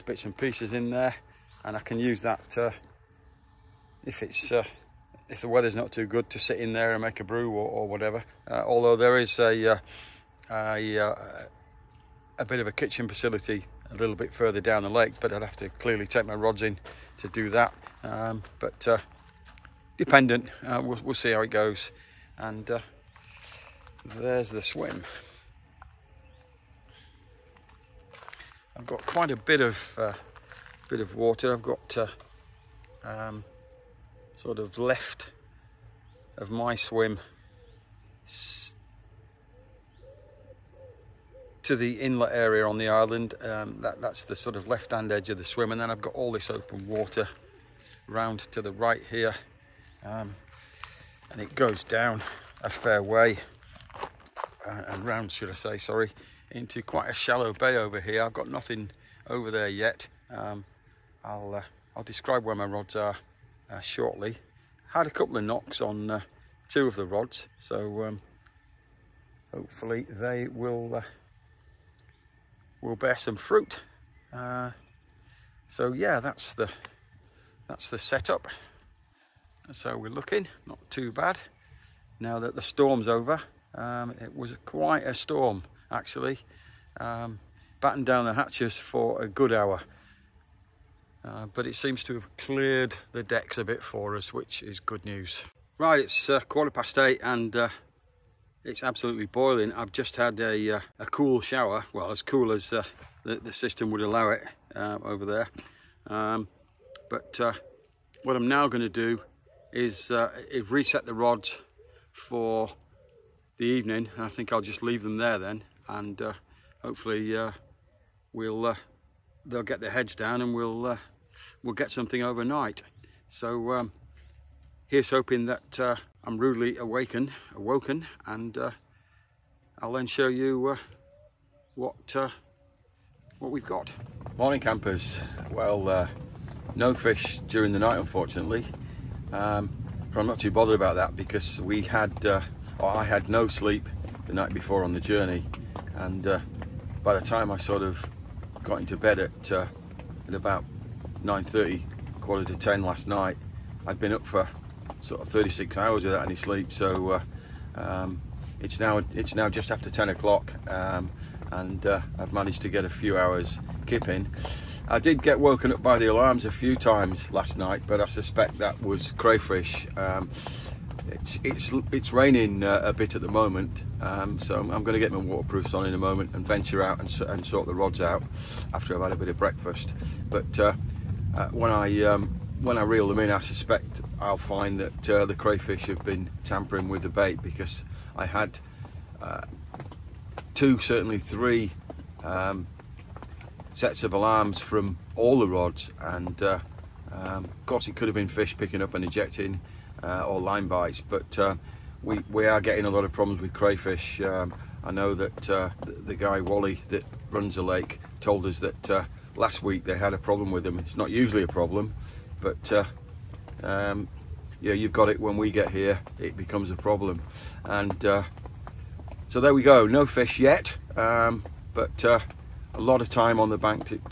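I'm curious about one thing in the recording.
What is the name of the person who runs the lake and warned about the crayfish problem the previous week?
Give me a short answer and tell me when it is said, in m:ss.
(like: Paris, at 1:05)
Wally, at 3:26.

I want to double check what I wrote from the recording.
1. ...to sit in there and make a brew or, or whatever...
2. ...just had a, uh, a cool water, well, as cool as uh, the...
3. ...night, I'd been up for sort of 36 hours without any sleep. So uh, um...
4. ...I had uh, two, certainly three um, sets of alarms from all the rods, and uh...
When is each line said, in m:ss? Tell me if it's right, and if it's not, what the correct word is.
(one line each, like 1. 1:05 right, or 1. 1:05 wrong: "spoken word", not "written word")
1. 0:06 right
2. 1:39 wrong: "shower", not "water"
3. 2:33 right
4. 3:08 right.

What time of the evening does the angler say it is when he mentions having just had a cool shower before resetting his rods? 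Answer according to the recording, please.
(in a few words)
quarter past eight.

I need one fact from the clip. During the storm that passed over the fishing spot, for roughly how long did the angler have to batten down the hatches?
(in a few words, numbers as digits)
a good hour.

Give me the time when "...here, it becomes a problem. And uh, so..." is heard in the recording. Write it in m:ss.
3:35.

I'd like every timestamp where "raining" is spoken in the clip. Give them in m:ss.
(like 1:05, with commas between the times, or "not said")
2:52.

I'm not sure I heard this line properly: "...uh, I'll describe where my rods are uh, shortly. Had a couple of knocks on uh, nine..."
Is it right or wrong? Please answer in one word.
wrong.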